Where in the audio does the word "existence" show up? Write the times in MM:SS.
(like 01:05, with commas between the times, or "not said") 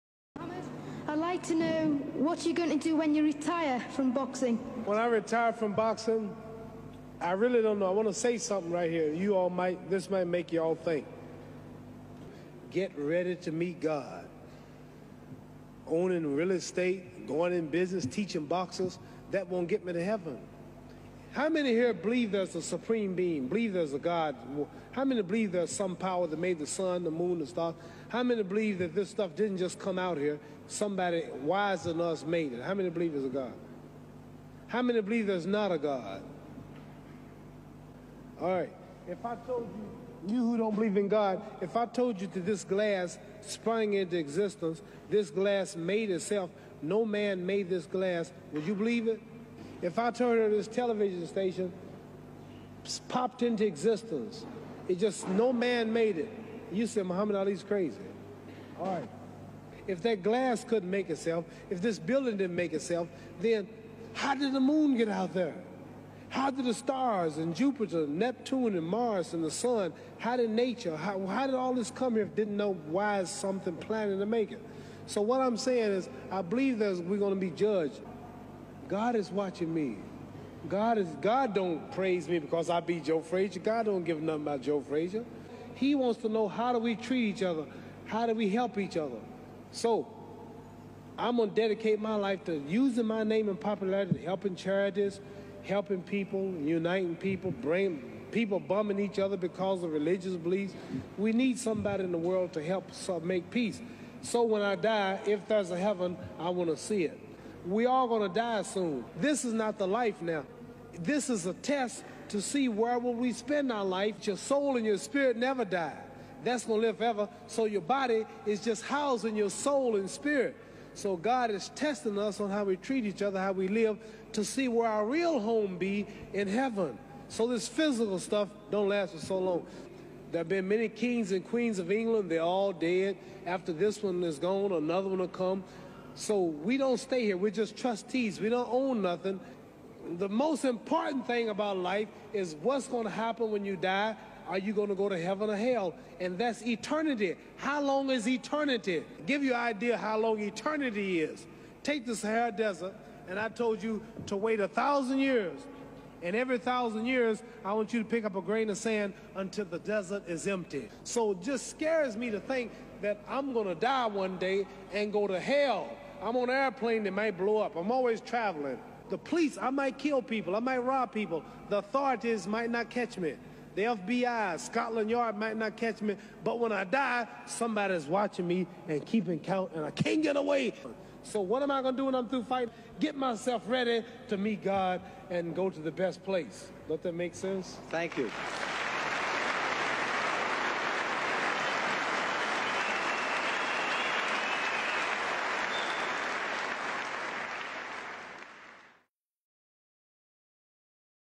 00:44, 00:53.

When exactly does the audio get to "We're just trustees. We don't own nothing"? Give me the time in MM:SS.
02:17.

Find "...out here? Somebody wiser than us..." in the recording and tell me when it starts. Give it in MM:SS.
00:29.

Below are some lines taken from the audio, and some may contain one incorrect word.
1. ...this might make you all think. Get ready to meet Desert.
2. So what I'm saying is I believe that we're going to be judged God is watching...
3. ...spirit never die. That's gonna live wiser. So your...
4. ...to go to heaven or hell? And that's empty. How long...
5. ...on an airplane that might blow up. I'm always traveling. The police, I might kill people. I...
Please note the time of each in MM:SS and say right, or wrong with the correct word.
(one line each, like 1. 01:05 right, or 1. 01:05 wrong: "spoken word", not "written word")
1. 00:09 wrong: "God", not "Desert"
2. 01:15 right
3. 01:54 wrong: "forever", not "wiser"
4. 02:24 wrong: "eternity", not "empty"
5. 02:46 right.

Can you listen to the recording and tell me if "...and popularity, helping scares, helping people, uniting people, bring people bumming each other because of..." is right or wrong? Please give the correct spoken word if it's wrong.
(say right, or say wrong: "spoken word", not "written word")
wrong: "charities", not "scares".